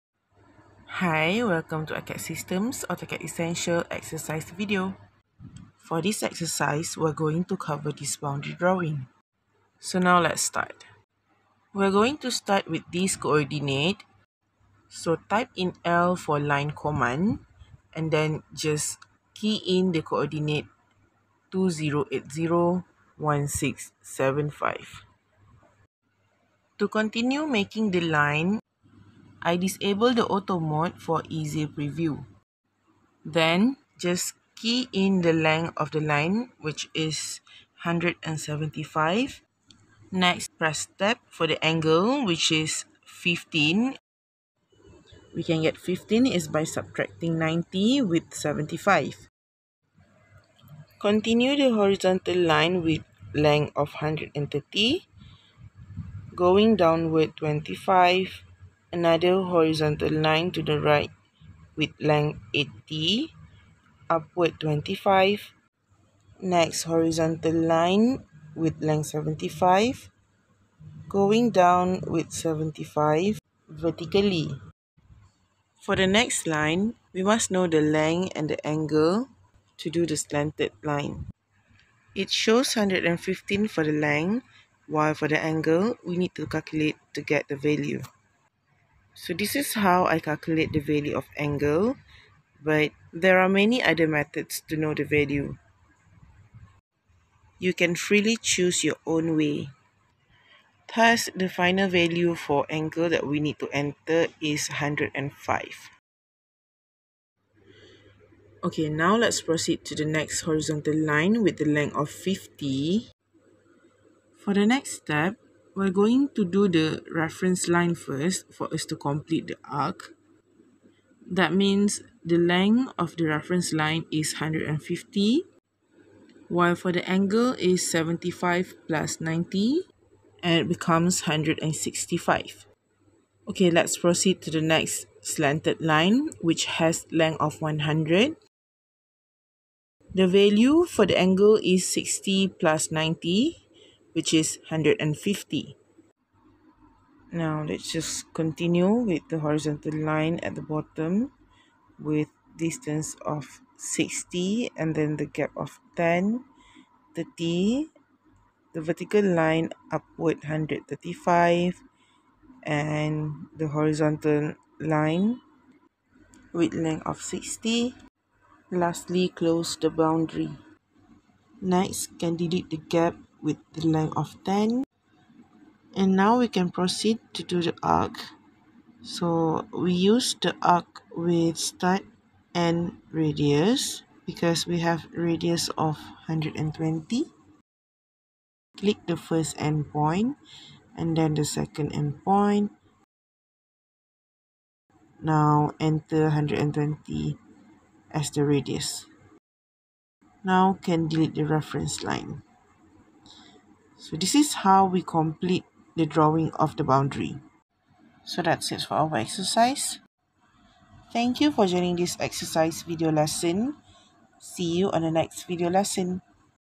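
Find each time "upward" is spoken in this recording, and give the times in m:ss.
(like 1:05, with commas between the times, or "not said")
1:04, 2:39.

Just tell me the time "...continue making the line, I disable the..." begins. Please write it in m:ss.
0:26.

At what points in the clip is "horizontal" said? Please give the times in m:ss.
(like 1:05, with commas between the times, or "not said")
0:51, 0:59, 1:06, 1:50, 2:29, 2:43.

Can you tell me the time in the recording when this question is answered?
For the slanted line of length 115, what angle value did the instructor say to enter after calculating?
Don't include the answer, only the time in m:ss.
1:44.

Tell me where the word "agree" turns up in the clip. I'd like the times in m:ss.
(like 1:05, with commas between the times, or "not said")
not said.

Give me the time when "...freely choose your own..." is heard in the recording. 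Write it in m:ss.
1:37.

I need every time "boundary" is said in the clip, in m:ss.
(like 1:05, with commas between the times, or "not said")
0:08, 2:49, 3:26.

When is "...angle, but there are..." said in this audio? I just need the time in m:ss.
1:31.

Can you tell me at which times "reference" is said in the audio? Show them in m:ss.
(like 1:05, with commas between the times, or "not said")
1:57, 2:03, 3:21.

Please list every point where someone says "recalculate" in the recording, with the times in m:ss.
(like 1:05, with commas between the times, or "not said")
not said.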